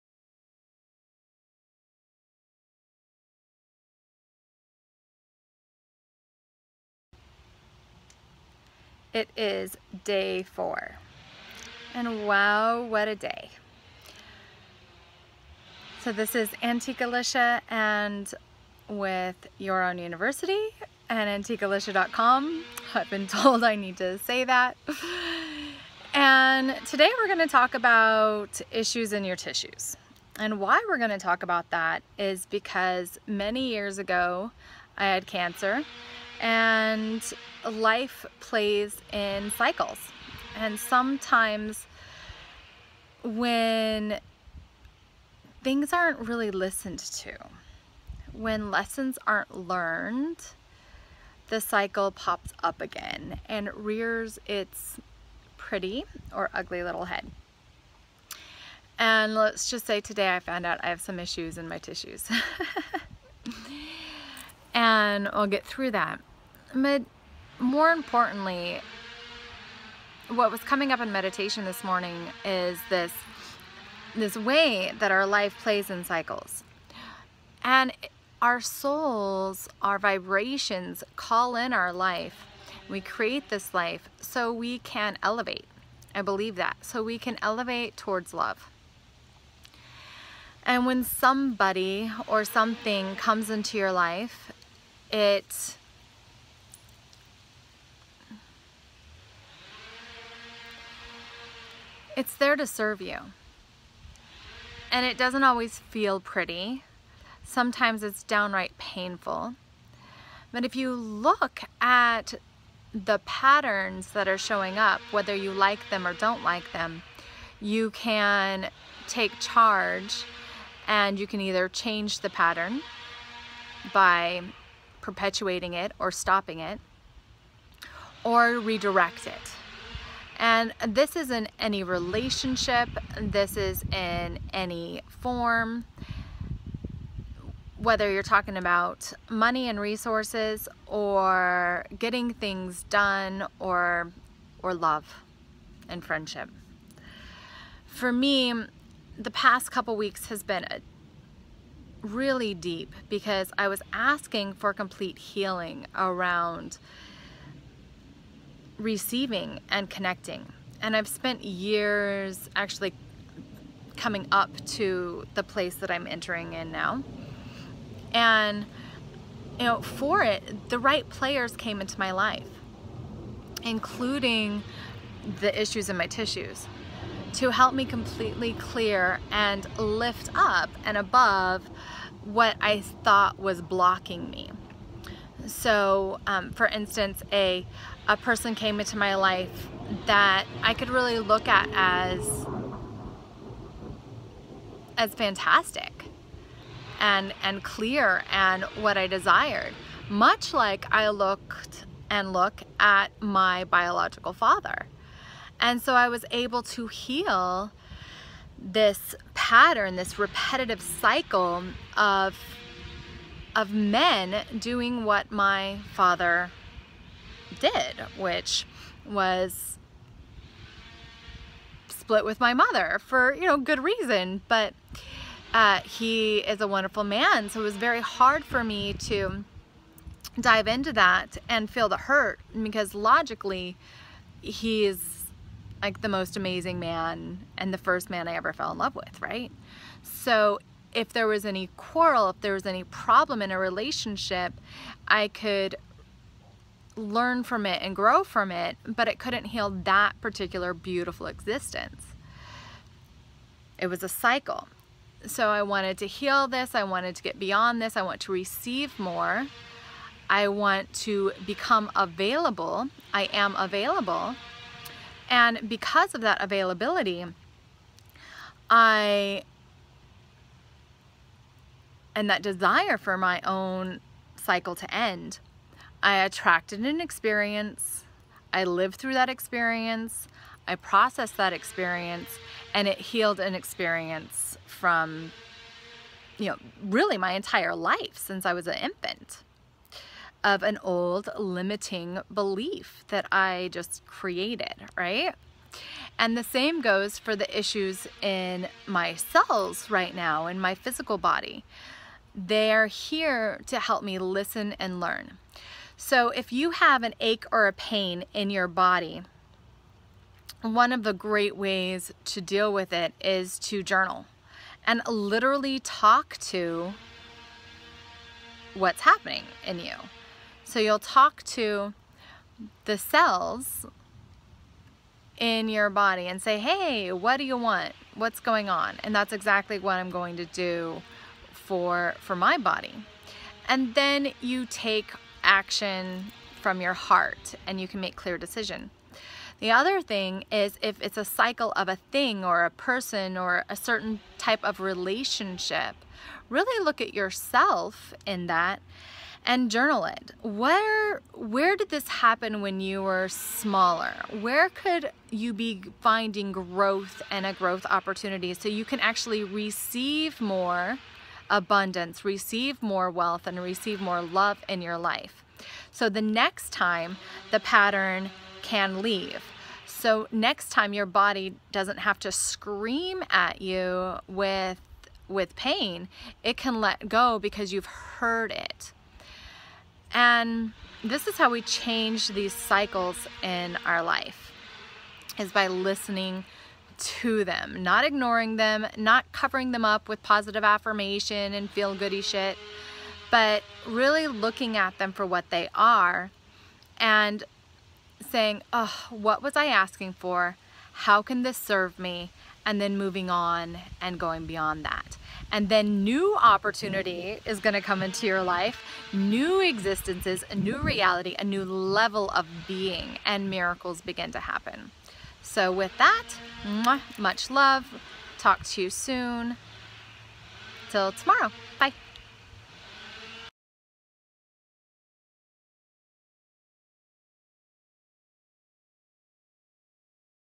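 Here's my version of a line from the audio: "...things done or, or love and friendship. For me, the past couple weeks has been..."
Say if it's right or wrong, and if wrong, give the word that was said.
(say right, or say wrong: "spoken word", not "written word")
right.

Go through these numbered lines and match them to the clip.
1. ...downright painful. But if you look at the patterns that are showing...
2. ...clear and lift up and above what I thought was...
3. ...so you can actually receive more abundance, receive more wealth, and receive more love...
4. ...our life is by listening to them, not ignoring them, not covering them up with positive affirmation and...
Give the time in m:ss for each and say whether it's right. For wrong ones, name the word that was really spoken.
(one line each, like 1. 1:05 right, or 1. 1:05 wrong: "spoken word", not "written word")
1. 1:48 right
2. 2:58 right
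3. 5:58 right
4. 6:23 right.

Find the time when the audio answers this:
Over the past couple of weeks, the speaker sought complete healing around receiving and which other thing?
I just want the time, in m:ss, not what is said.
2:39.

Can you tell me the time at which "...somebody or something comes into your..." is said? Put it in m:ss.
1:31.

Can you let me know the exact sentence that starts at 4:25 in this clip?
And because of that availability, I and that desire for my own cycle to end.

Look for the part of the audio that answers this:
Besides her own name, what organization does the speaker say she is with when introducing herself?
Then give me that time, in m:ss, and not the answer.
0:19.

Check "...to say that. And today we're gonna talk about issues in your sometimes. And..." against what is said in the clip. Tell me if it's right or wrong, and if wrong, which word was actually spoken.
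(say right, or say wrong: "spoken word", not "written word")
wrong: "tissues", not "sometimes".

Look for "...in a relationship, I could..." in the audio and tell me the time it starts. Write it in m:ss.
4:03.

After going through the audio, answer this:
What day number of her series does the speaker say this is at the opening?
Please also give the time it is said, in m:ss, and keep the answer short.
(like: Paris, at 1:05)
4, at 0:10.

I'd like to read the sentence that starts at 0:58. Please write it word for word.
And let's just say today I found out I have some issues in my tissues.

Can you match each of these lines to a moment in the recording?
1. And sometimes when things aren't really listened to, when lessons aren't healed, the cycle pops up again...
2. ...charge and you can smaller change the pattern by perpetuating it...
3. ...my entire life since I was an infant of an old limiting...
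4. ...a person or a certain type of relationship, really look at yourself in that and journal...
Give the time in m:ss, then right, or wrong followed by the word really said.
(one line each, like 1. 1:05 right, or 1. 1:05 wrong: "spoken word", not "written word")
1. 0:40 wrong: "learned", not "healed"
2. 1:59 wrong: "either", not "smaller"
3. 4:47 right
4. 5:42 right.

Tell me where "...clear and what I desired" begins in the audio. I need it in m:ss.
3:17.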